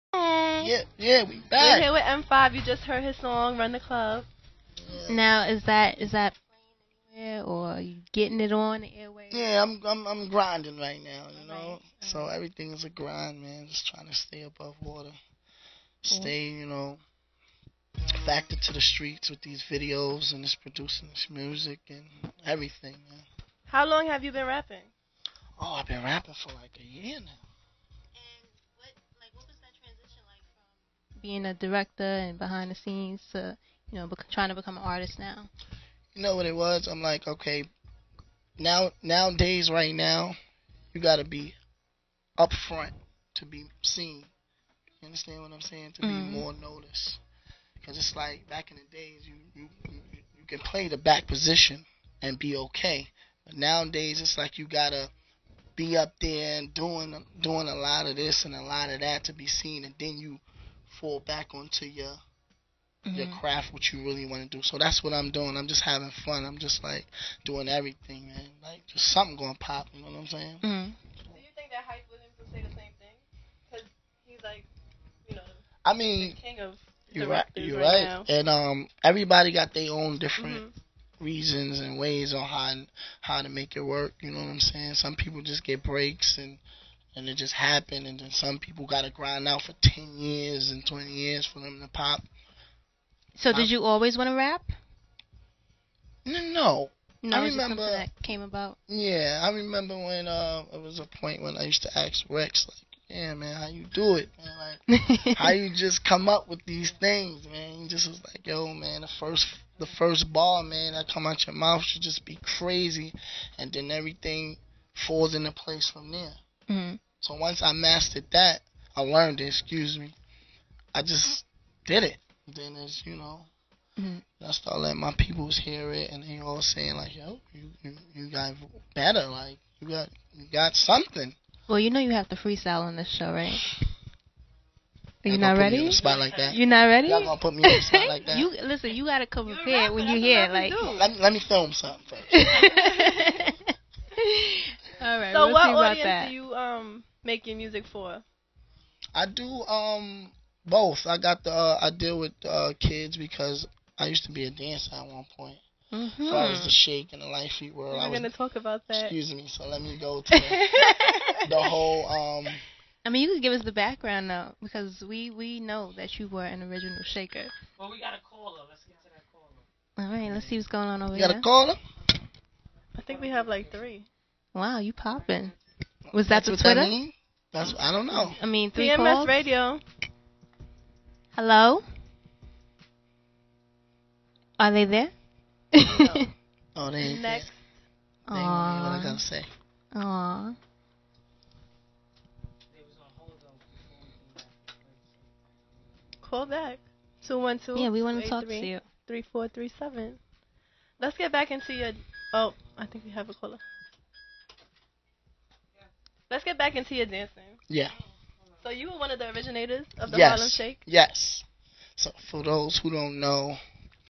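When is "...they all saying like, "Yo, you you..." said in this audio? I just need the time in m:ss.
2:06.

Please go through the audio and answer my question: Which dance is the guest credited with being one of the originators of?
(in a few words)
Harlem Shake.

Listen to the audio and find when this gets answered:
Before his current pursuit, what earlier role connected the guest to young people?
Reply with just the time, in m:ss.
2:34.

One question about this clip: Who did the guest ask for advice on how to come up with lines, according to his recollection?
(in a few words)
Rex.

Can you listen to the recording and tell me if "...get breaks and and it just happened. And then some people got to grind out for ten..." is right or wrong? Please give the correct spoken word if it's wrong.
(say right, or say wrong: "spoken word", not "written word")
right.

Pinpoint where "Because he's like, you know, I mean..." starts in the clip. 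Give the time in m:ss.
1:13.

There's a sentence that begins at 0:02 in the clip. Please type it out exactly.
You just heard his song, Run the Club.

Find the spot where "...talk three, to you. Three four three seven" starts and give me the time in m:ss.
3:18.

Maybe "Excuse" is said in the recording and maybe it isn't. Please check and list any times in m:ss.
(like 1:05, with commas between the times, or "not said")
1:59, 2:39.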